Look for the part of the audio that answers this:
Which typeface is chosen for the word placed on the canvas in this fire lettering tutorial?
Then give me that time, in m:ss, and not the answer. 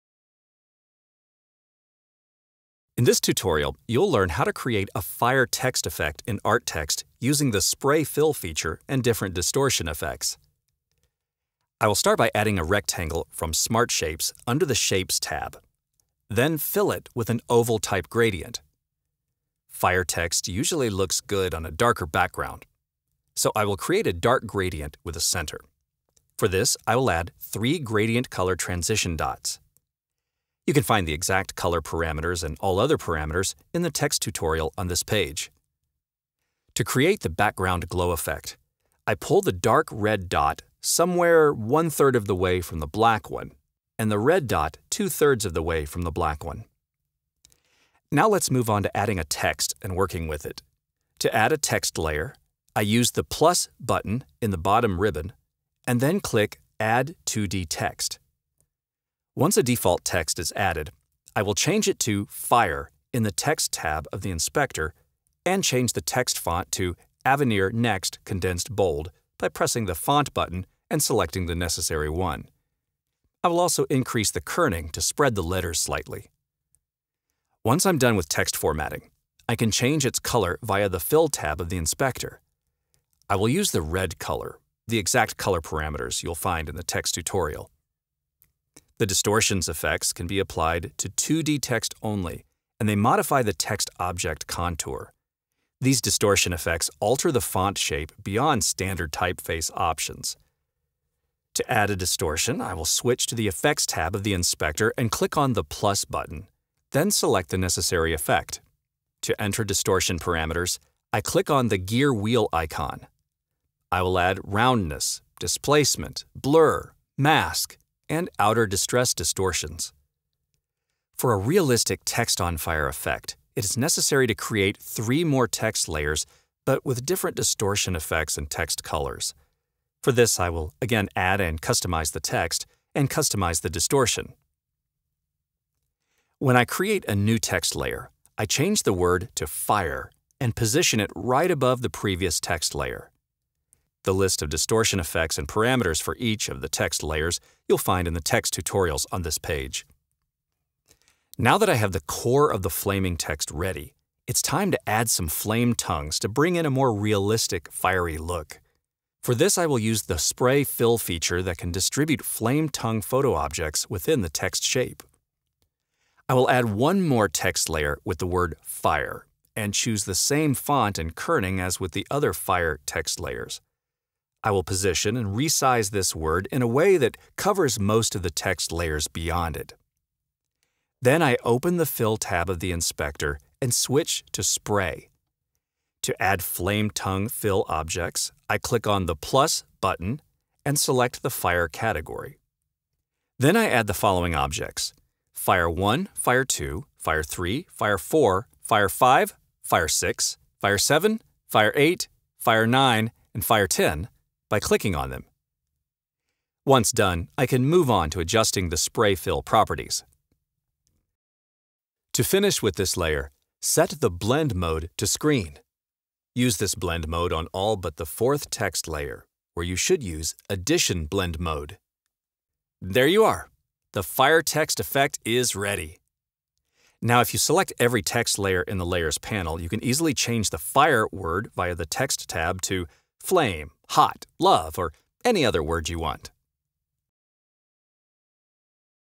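1:07.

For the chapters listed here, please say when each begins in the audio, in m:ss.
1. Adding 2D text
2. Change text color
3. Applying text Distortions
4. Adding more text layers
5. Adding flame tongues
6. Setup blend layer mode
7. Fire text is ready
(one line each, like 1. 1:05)
1. 0:52
2. 1:17
3. 1:28
4. 2:11
5. 2:30
6. 3:31
7. 3:42.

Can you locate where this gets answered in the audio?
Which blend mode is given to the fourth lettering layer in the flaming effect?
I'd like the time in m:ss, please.
3:40.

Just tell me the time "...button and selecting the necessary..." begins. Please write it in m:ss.
1:10.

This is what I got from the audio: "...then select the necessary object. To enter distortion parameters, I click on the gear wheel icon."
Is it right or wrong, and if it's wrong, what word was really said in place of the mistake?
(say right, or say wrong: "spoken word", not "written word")
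wrong: "effect", not "object".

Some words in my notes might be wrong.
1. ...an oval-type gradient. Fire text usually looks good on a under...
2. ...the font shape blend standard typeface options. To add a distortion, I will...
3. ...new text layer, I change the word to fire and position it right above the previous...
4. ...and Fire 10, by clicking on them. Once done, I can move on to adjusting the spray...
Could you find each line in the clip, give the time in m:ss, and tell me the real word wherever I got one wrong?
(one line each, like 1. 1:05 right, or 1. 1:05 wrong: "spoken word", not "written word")
1. 0:17 wrong: "darker", not "under"
2. 1:37 wrong: "beyond", not "blend"
3. 2:17 right
4. 3:23 right.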